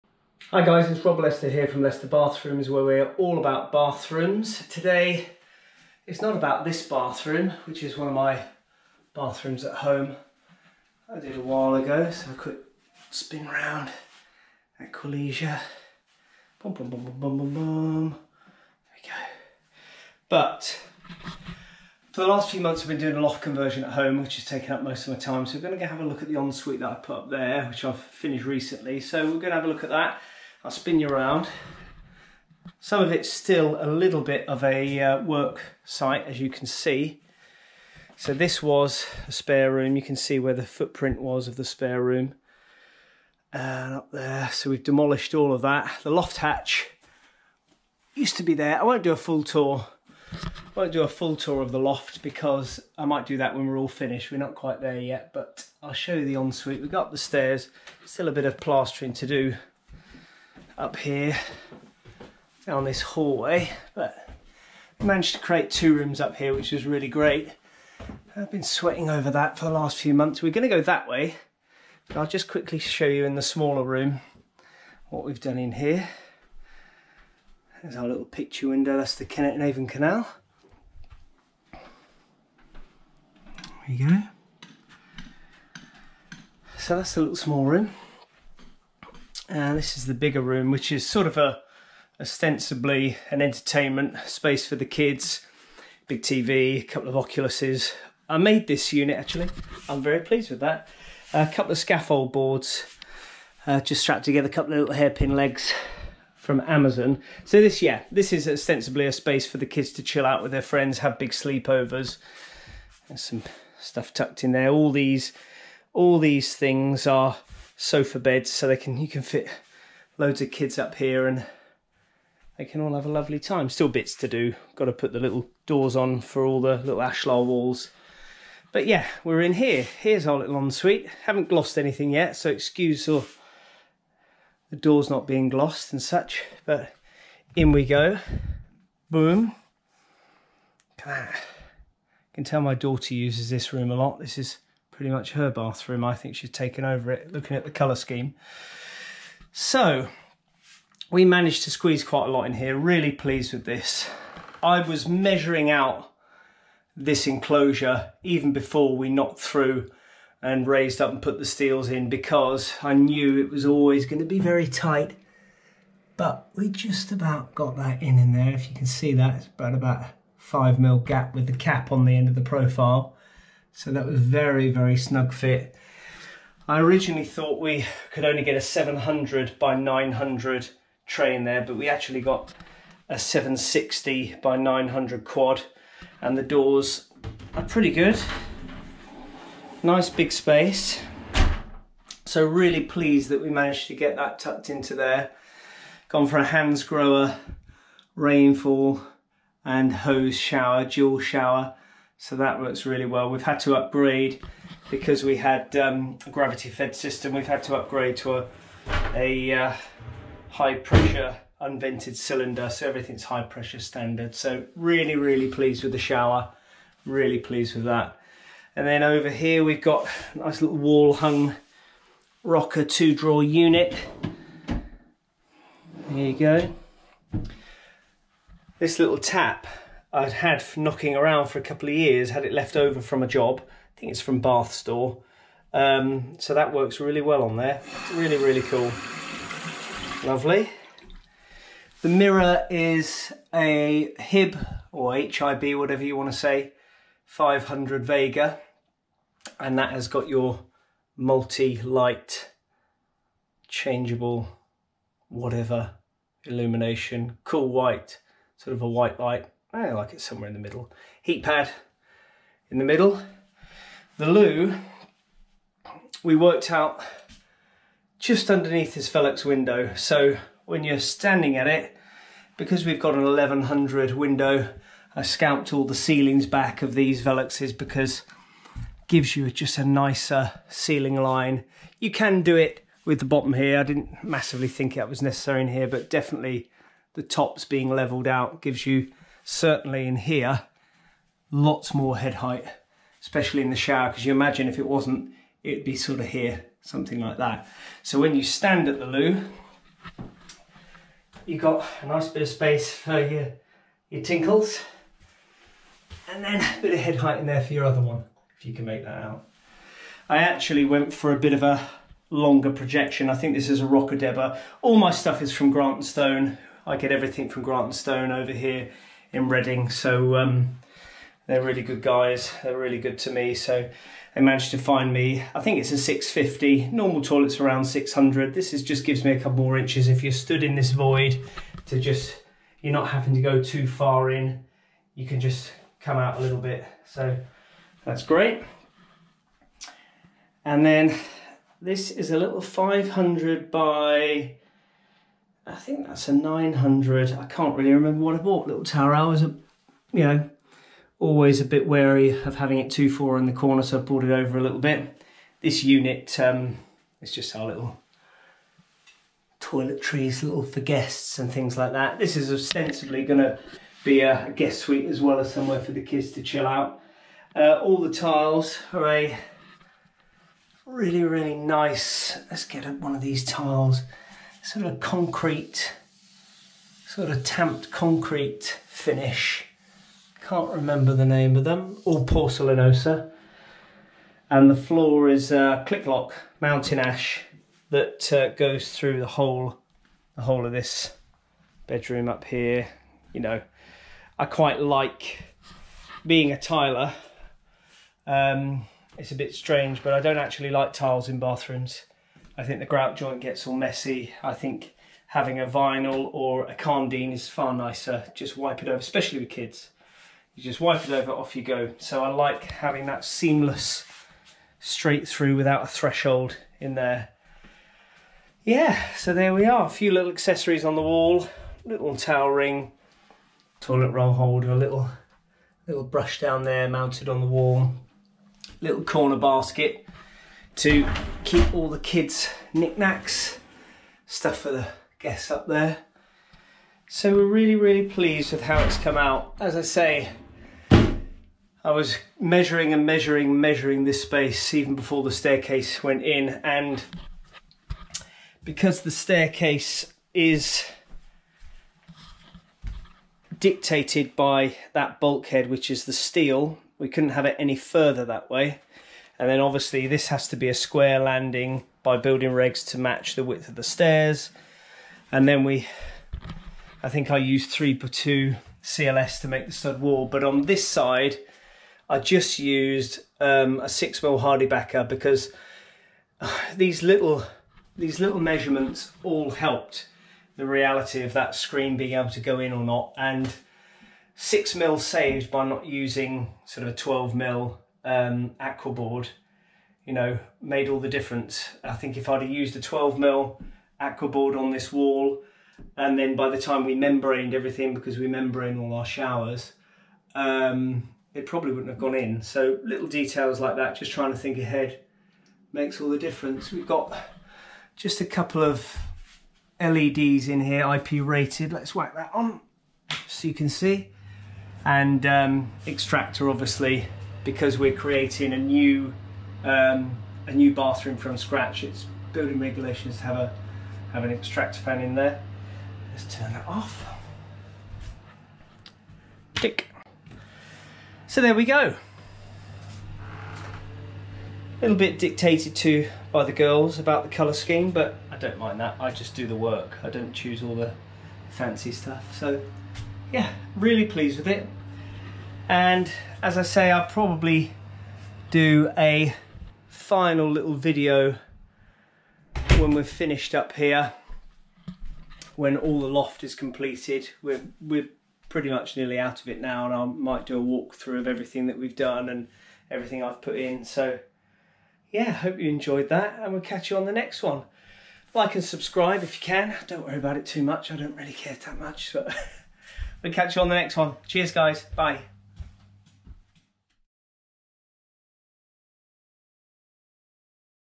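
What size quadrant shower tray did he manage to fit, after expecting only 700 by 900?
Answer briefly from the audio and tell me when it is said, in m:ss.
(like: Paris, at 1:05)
760 by 900, at 3:03.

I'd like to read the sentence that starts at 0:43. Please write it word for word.
And up there, so we've demolished all of that.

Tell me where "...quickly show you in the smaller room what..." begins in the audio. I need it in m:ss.
1:12.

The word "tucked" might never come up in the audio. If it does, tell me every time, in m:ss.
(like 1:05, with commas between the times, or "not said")
1:54, 3:14.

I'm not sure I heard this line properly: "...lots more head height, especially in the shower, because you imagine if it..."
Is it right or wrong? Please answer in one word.
right.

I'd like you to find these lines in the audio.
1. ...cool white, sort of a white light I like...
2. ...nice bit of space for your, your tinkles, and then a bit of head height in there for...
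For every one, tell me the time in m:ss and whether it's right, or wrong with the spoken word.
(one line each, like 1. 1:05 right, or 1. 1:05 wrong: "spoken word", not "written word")
1. 4:17 right
2. 5:02 right.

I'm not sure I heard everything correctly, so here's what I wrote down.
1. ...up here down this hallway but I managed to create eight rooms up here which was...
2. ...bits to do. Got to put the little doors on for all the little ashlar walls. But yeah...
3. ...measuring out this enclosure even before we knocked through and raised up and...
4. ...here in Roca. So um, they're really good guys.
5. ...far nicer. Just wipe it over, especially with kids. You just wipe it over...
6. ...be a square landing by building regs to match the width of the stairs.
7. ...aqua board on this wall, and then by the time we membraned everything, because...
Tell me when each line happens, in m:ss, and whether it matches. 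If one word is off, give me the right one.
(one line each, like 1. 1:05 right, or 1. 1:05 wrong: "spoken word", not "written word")
1. 1:00 wrong: "two", not "eight"
2. 2:03 right
3. 2:35 right
4. 5:18 wrong: "Reading", not "Roca"
5. 6:47 right
6. 7:40 right
7. 8:13 right.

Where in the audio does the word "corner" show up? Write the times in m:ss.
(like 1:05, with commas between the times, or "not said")
5:53, 7:09.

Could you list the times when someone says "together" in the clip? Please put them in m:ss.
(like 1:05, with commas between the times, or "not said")
1:44.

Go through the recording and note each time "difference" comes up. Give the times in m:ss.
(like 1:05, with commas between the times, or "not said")
8:11, 8:26.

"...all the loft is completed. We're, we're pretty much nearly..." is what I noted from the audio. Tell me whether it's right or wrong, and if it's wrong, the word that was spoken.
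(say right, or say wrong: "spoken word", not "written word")
right.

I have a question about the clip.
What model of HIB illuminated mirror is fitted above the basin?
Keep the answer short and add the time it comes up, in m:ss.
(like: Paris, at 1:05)
500 Vega, at 4:07.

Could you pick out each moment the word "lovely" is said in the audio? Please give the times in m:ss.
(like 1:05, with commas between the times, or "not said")
2:03, 4:00.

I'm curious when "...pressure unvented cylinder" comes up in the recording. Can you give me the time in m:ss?
3:30.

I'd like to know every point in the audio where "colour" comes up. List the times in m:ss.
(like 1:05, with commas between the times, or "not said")
2:27, 8:57.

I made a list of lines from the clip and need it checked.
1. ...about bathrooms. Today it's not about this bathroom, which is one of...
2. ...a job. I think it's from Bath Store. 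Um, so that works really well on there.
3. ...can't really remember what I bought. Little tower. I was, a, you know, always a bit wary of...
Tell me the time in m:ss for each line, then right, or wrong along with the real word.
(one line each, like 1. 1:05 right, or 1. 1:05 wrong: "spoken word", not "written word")
1. 0:03 right
2. 3:53 right
3. 5:47 right.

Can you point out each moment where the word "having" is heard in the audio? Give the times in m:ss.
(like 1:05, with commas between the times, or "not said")
5:33, 5:52, 6:45, 6:52.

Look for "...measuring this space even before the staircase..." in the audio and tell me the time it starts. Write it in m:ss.
7:23.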